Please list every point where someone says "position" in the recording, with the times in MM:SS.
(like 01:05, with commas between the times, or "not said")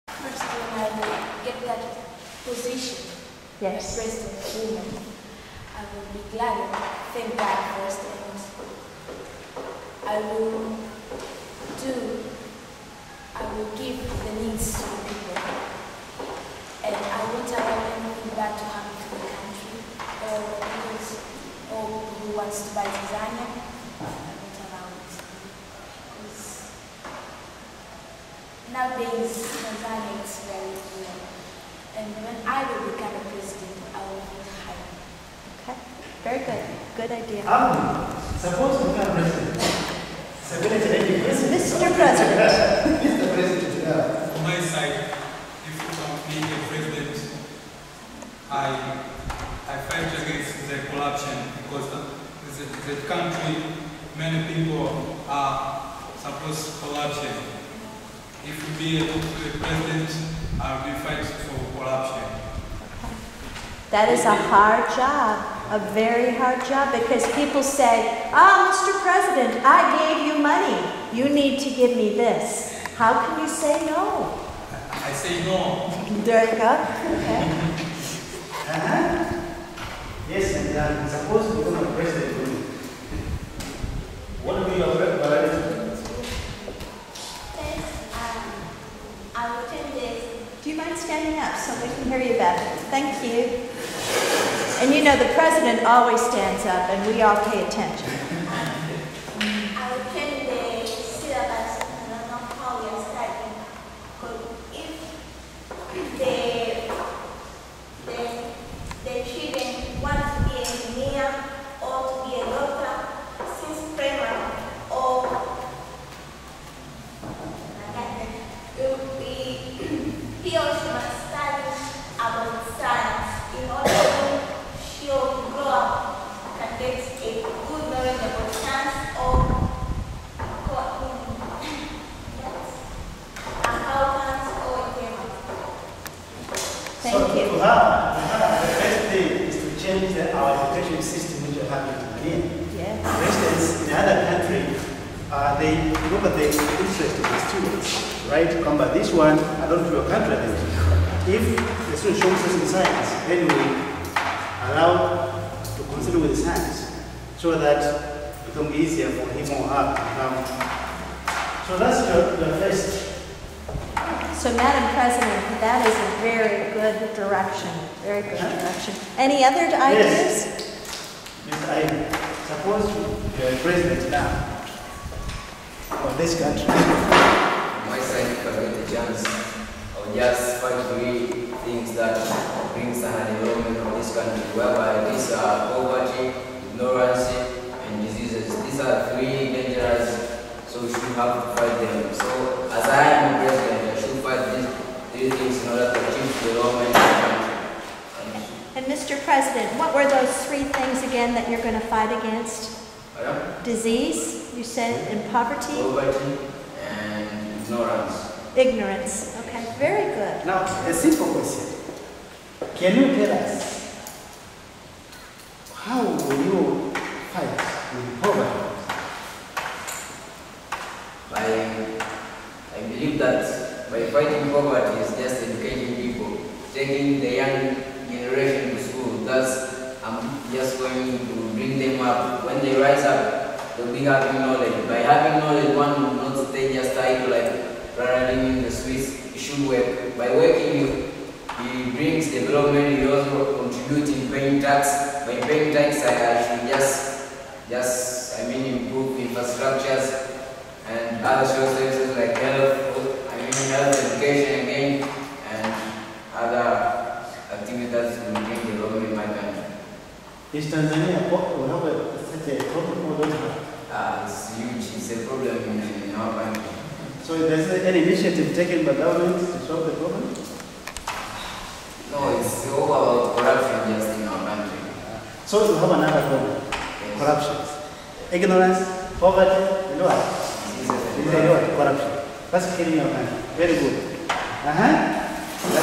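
00:02.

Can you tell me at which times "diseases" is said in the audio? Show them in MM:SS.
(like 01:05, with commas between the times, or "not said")
03:08, 03:23.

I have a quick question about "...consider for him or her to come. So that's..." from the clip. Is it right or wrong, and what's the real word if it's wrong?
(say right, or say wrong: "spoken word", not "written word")
wrong: "easier", not "consider".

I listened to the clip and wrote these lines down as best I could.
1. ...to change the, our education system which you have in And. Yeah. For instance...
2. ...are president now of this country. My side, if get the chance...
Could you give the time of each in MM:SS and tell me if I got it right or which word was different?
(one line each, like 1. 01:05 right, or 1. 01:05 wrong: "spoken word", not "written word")
1. 02:19 wrong: "Tanzania", not "And"
2. 02:53 right.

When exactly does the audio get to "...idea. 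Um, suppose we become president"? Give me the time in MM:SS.
00:37.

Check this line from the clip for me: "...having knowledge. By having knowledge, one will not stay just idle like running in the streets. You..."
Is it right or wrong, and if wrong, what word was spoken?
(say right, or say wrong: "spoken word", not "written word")
right.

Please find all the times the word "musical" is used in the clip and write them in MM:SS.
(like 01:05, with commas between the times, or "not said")
not said.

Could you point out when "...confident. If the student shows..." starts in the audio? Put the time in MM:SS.
02:30.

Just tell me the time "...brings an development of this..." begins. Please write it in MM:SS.
03:02.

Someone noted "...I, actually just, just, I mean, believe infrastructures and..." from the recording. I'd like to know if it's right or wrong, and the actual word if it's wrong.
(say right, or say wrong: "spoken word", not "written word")
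wrong: "improve", not "believe".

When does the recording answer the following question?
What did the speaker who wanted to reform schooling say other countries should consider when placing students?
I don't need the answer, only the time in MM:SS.
02:26.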